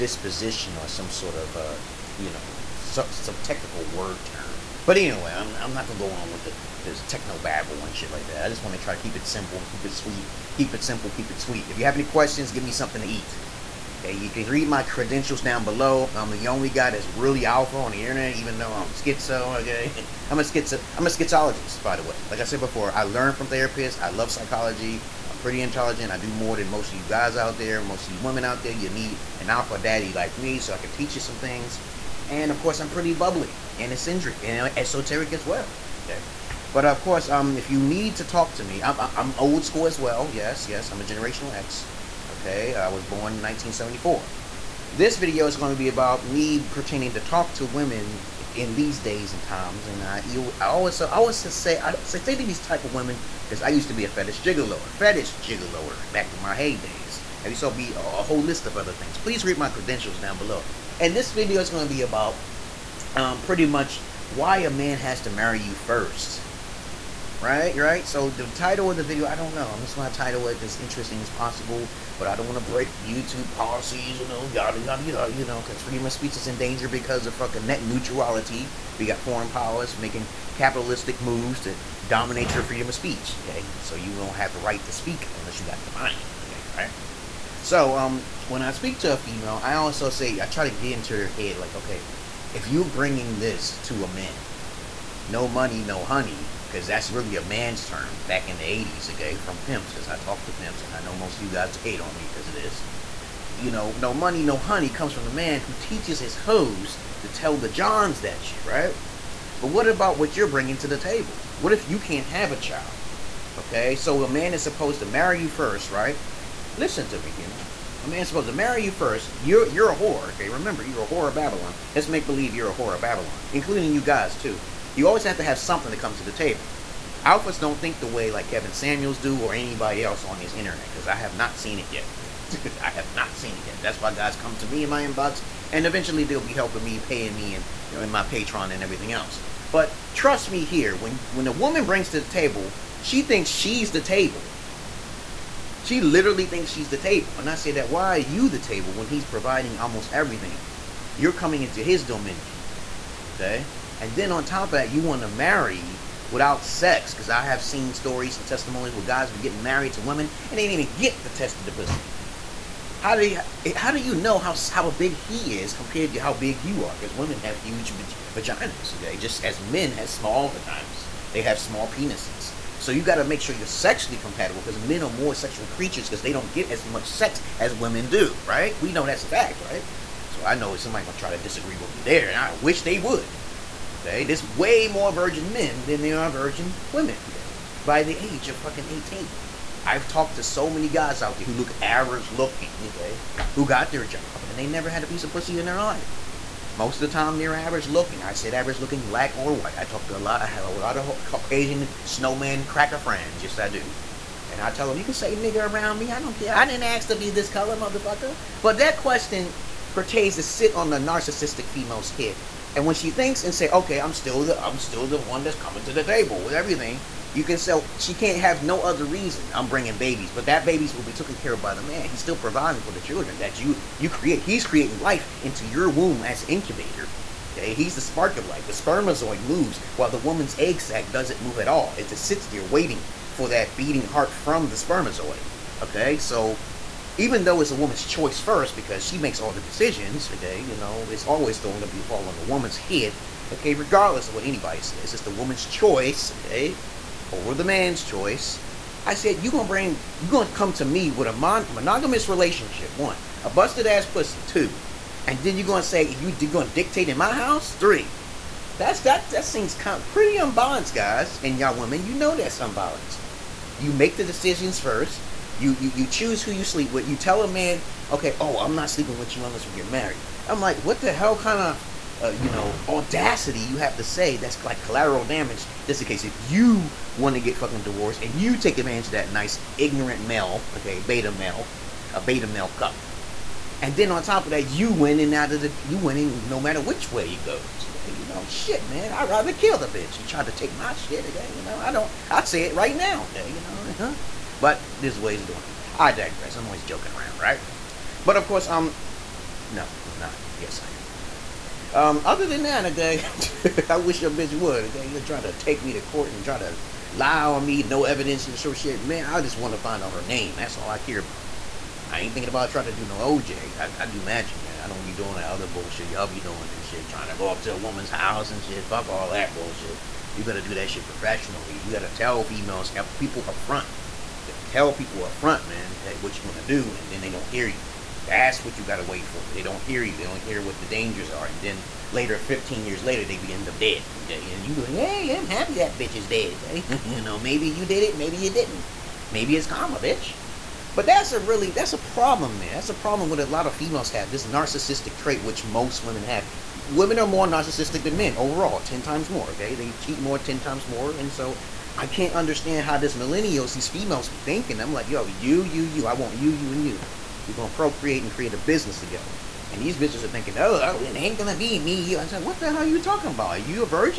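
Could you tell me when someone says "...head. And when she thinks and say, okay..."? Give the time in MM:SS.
03:32.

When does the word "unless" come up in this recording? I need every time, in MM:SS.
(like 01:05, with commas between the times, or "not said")
01:25, 04:29.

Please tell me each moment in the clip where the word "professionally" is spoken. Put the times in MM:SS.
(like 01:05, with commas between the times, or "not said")
05:21.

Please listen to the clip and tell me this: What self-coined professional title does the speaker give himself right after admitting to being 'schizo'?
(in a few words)
schizologist.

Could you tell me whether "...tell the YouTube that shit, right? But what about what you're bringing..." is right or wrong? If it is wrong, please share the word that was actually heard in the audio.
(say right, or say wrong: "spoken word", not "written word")
wrong: "Johns", not "YouTube".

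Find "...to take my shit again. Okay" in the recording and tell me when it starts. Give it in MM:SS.
04:50.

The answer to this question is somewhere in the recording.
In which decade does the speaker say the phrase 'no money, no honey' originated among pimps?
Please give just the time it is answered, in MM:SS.
01:38.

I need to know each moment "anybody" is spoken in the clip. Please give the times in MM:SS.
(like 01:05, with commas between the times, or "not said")
02:09, 04:04.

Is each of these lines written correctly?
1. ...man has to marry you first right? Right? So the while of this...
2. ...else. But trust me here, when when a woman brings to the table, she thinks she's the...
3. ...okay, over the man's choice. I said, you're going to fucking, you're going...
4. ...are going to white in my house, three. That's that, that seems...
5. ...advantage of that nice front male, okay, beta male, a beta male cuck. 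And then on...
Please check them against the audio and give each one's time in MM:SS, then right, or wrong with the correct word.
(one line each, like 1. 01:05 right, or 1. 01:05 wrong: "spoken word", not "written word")
1. 01:04 wrong: "title", not "while"
2. 02:19 right
3. 04:06 wrong: "bring", not "fucking"
4. 04:16 wrong: "dictate", not "white"
5. 04:38 wrong: "ignorant", not "front".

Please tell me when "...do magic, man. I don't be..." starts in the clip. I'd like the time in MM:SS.
05:14.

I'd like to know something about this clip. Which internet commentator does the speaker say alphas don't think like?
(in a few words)
Kevin Samuels.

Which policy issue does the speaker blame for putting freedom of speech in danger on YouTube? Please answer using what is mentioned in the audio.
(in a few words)
net neutrality.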